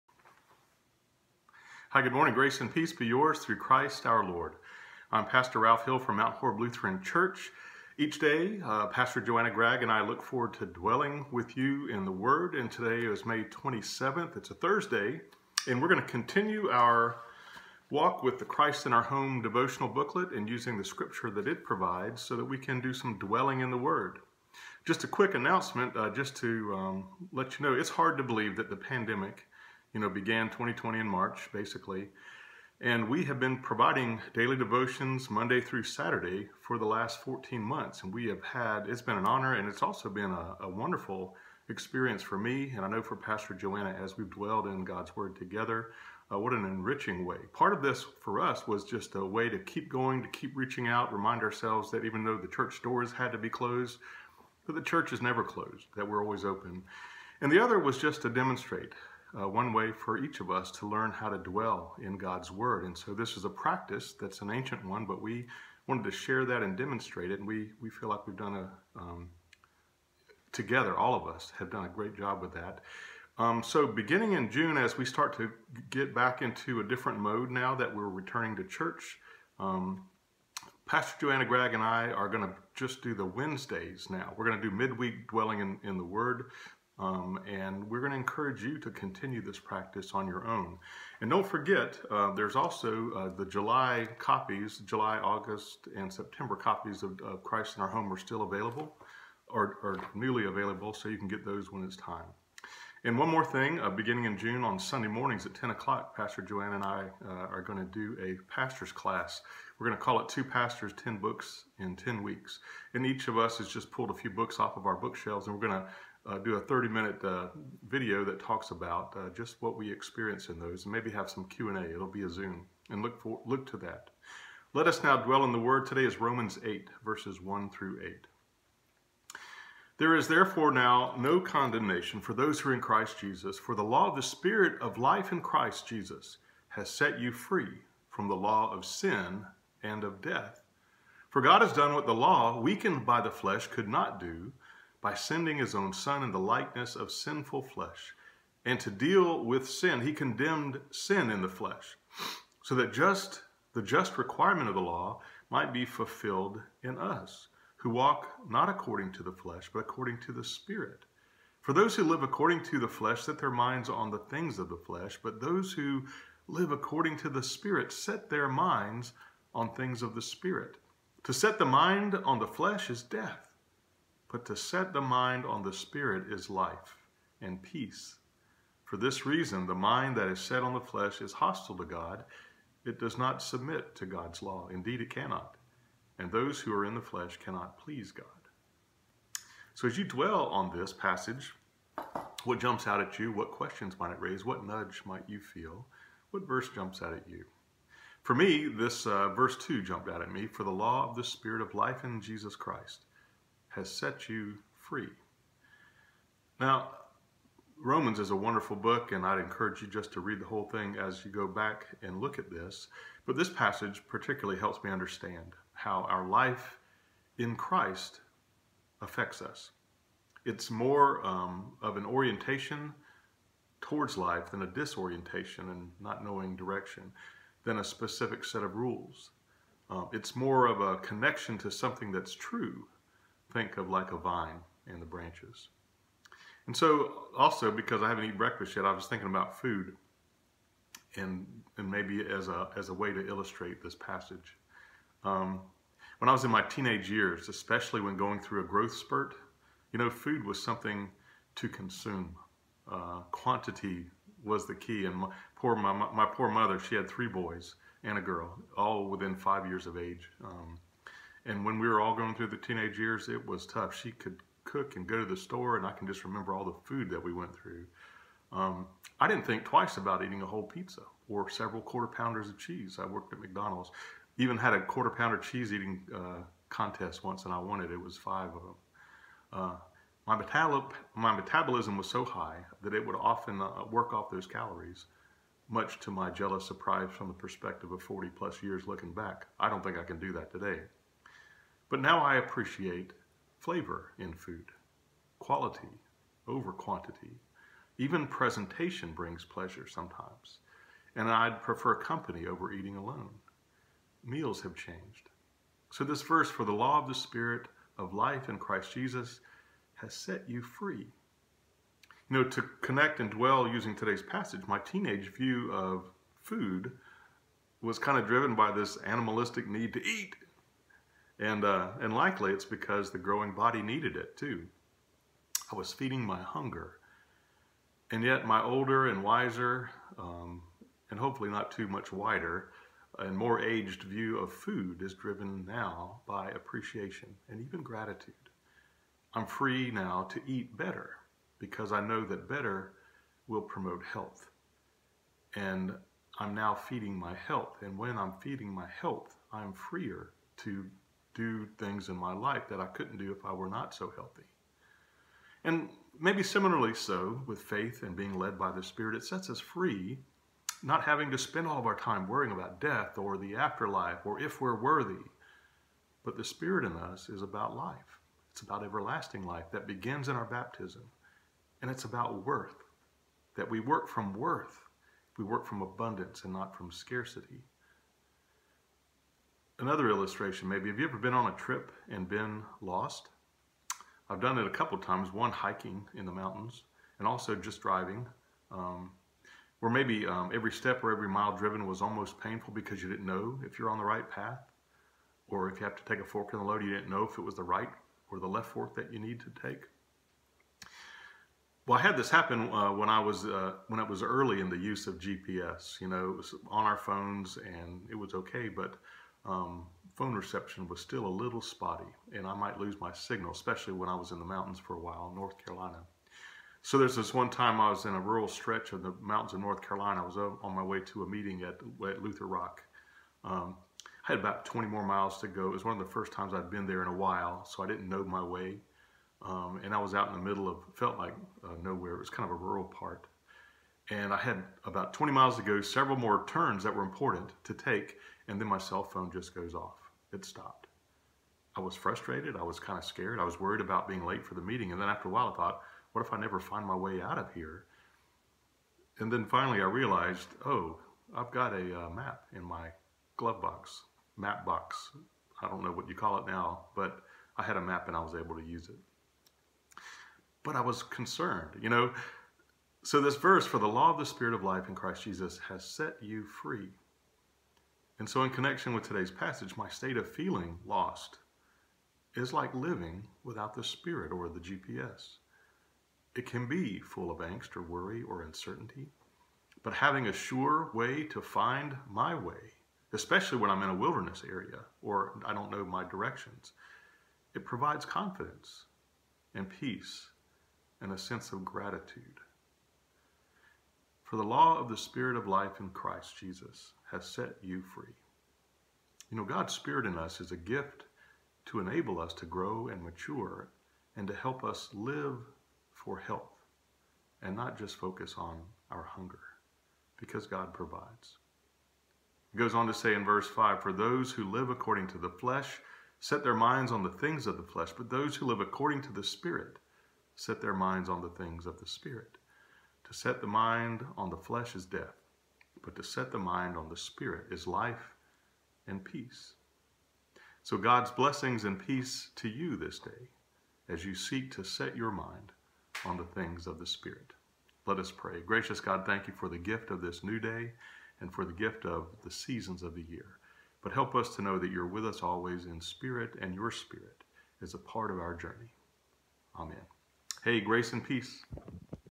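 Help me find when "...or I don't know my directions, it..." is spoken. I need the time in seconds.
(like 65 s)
485 s.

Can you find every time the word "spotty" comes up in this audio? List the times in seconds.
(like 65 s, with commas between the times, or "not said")
411 s.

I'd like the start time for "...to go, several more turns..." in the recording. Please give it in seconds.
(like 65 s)
435 s.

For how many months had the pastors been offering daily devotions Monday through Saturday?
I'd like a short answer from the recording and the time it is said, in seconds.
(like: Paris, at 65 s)
14, at 37 s.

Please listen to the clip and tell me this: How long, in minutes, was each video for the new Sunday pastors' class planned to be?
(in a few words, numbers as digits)
30.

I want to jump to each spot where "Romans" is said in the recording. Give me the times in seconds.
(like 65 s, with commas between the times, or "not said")
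126 s, 207 s.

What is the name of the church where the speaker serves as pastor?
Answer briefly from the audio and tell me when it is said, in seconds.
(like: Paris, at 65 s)
Mount Horeb Lutheran Church, at 6 s.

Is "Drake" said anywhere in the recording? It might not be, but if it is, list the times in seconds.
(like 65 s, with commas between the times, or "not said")
not said.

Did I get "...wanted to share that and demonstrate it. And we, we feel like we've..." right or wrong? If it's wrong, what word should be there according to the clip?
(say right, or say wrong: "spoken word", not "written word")
right.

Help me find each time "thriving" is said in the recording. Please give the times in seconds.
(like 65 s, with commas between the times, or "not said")
not said.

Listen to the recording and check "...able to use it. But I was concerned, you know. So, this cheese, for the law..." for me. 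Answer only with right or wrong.
wrong.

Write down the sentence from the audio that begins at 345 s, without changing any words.
And I'm now feeding my health.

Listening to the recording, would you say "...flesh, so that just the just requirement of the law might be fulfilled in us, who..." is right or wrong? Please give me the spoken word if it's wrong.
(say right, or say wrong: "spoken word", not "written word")
right.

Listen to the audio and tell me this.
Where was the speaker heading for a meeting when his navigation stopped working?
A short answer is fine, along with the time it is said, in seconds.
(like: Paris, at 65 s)
Lutherock, at 422 s.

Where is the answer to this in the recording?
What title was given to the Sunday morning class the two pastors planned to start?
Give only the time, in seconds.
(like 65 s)
110 s.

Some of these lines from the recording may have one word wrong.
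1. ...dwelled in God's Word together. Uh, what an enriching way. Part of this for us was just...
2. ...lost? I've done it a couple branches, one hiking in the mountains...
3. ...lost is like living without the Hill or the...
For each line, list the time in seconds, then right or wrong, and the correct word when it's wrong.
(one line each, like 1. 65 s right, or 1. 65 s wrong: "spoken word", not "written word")
1. 44 s right
2. 382 s wrong: "times", not "branches"
3. 470 s wrong: "Spirit", not "Hill".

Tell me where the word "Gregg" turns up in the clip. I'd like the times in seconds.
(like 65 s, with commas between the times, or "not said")
9 s, 81 s.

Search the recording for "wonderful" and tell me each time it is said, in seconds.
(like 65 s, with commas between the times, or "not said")
40 s, 208 s.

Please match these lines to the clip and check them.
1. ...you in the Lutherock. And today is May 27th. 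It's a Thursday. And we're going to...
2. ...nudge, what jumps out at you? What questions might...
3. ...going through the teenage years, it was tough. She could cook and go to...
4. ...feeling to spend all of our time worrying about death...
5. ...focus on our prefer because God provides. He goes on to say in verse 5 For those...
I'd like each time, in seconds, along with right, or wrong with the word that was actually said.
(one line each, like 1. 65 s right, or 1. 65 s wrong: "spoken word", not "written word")
1. 11 s wrong: "Word", not "Lutherock"
2. 190 s wrong: "passage", not "nudge"
3. 262 s right
4. 361 s wrong: "having", not "feeling"
5. 507 s wrong: "hunger", not "prefer".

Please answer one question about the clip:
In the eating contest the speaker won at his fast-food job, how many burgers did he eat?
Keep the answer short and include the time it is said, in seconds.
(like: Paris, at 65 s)
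5, at 278 s.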